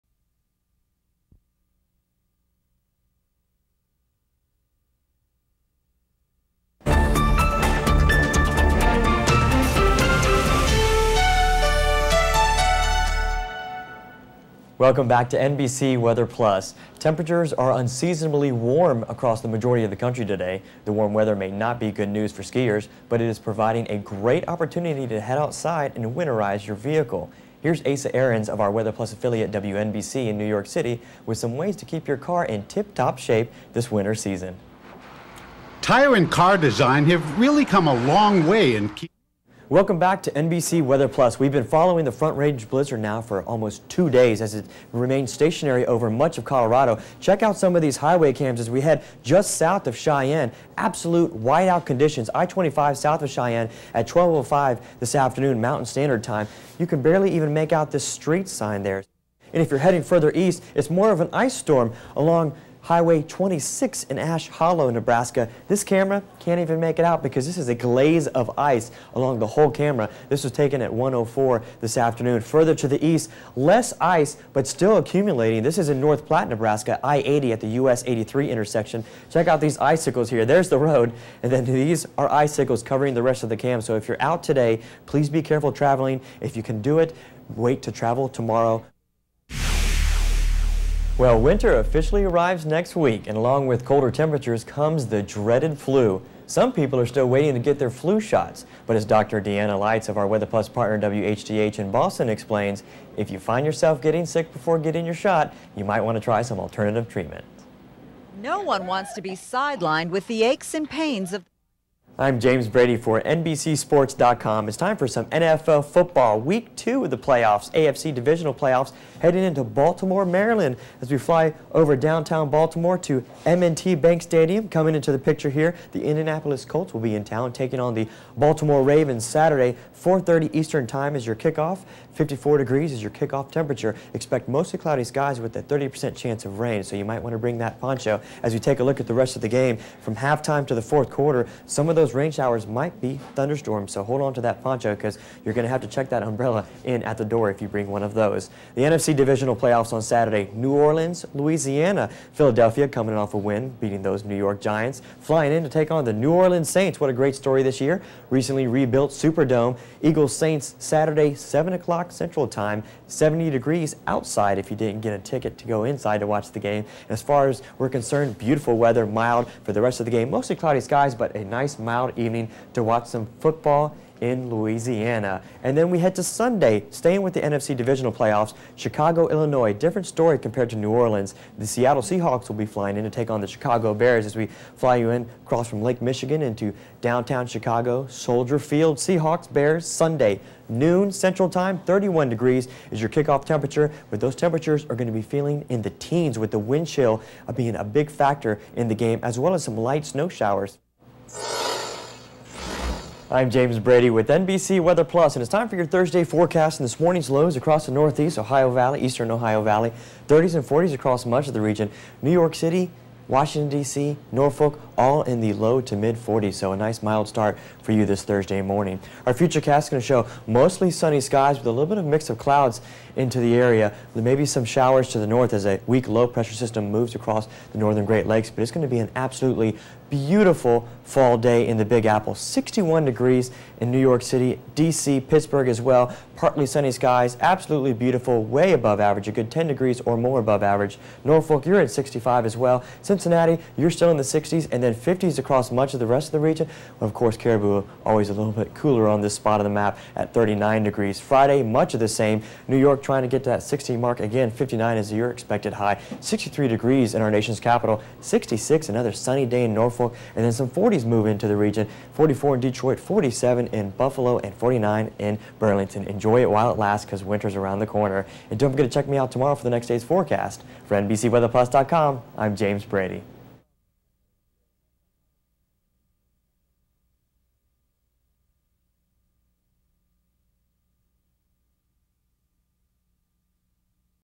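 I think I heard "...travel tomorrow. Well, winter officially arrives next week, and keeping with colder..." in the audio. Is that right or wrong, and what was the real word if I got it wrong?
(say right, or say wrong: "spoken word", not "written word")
wrong: "along", not "keeping".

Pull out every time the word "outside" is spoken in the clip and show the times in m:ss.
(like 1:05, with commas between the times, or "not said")
0:25, 2:44.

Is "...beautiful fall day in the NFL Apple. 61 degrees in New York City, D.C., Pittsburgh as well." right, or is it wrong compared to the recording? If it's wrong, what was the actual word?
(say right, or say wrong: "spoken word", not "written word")
wrong: "Big", not "NFL".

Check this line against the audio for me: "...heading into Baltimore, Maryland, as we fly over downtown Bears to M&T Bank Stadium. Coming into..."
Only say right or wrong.
wrong.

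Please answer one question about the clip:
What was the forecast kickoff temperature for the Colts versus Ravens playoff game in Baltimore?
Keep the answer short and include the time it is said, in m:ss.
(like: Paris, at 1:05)
54 degrees, at 2:12.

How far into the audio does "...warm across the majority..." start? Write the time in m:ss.
0:18.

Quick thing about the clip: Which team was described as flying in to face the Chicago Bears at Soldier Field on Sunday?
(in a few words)
Seattle Seahawks.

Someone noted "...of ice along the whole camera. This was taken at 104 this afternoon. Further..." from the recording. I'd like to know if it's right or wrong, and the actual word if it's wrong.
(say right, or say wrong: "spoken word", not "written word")
right.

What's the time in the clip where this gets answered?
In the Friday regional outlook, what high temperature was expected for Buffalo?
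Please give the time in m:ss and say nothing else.
4:22.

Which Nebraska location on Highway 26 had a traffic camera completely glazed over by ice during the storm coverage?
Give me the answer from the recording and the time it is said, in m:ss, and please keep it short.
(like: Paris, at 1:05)
Ash Hollow, at 1:04.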